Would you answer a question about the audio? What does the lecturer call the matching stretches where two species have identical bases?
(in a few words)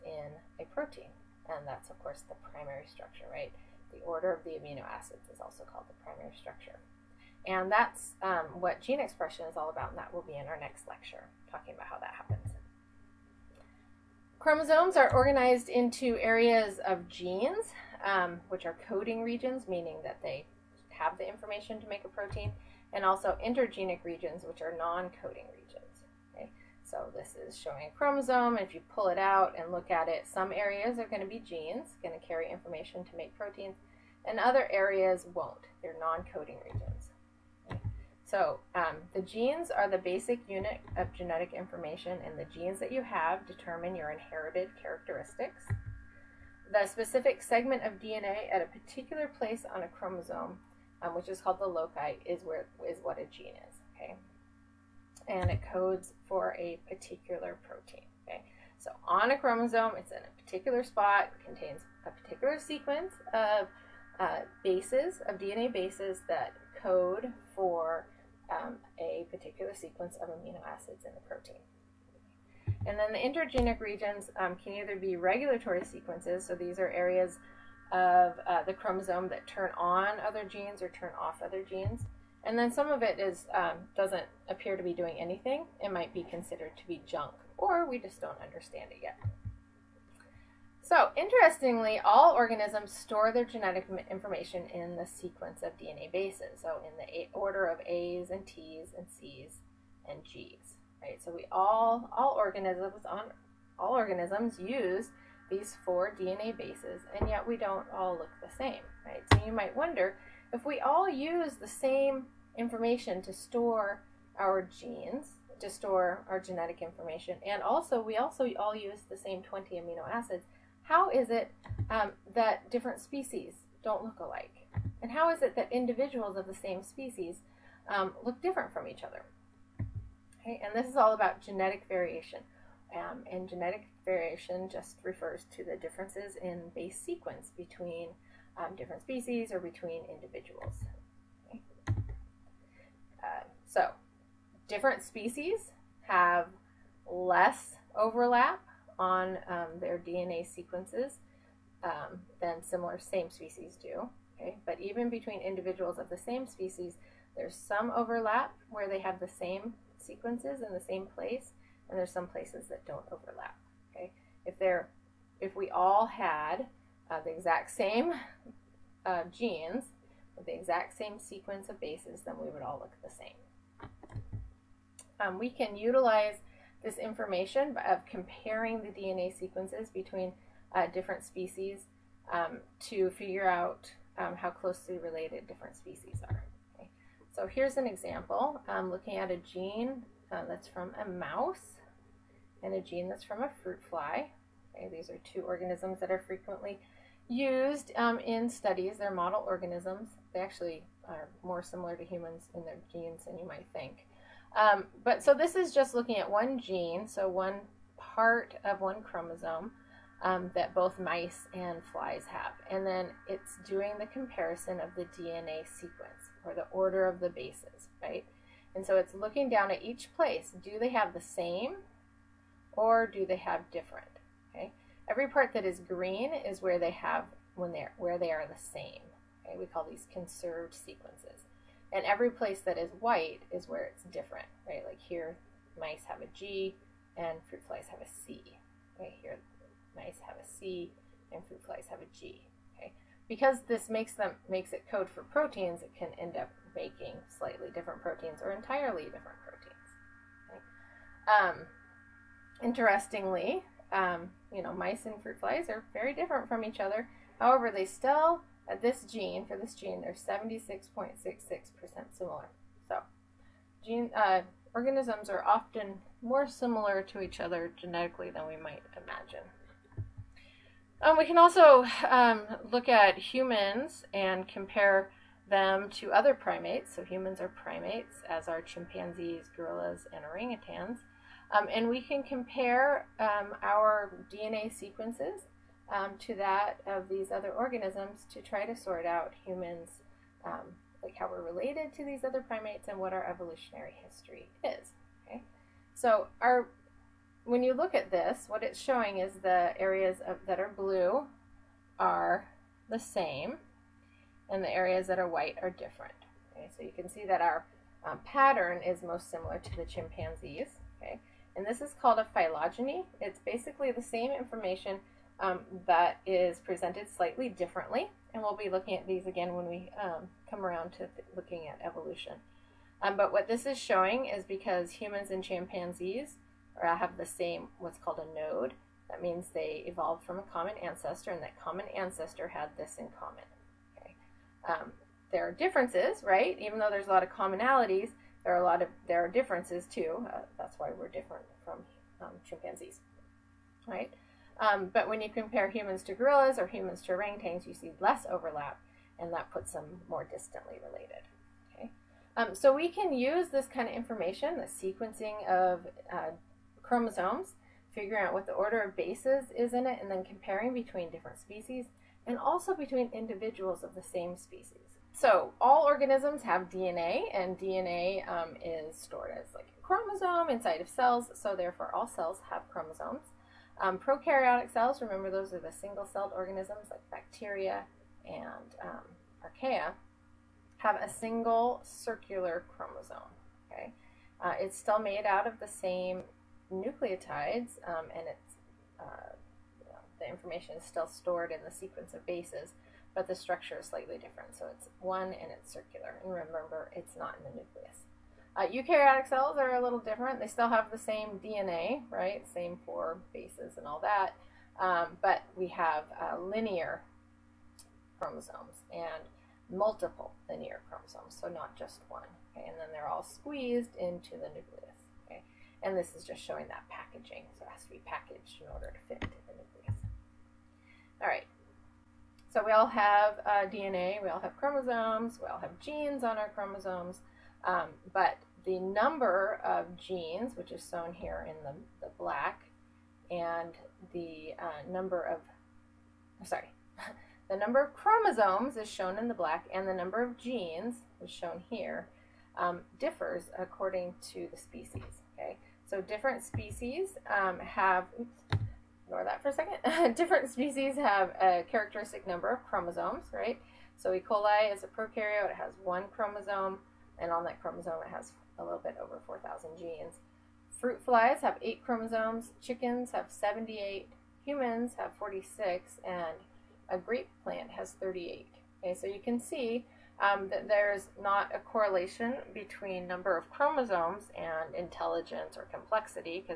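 conserved sequences.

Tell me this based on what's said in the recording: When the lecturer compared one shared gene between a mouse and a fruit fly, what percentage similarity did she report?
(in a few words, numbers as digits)
76.66%.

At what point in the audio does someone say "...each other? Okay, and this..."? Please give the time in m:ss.
2:08.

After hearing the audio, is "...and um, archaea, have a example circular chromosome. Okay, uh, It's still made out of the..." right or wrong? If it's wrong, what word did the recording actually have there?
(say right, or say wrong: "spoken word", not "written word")
wrong: "single", not "example".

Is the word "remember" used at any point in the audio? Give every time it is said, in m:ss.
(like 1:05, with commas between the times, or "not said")
6:15, 6:36.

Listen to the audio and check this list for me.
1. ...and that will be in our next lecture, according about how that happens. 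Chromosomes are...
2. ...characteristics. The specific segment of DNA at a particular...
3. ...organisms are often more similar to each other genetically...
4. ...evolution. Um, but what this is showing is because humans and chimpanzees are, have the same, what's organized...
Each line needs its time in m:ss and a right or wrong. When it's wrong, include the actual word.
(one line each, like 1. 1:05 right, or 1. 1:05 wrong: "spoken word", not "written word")
1. 0:09 wrong: "talking", not "according"
2. 0:44 right
3. 4:24 right
4. 5:21 wrong: "called", not "organized".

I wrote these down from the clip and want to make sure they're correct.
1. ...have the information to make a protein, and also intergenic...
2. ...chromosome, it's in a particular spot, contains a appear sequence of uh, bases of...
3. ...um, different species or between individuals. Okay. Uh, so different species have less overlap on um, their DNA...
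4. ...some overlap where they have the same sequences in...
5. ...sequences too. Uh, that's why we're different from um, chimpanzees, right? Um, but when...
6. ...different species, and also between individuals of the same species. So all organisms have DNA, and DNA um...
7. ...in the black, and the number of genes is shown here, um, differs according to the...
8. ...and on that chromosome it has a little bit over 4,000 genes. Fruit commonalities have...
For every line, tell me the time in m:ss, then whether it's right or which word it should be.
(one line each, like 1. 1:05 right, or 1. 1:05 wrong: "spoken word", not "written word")
1. 0:20 right
2. 0:59 wrong: "particular", not "appear"
3. 2:18 right
4. 2:37 right
5. 5:39 wrong: "differences", not "sequences"
6. 6:01 right
7. 7:19 right
8. 7:37 wrong: "flies", not "commonalities".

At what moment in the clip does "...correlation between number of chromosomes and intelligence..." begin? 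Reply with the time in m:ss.
7:51.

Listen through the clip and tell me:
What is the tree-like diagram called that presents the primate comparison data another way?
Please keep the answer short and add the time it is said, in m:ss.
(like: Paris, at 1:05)
phylogeny, at 5:12.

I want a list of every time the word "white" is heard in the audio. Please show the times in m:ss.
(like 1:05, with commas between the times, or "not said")
3:52, 5:05.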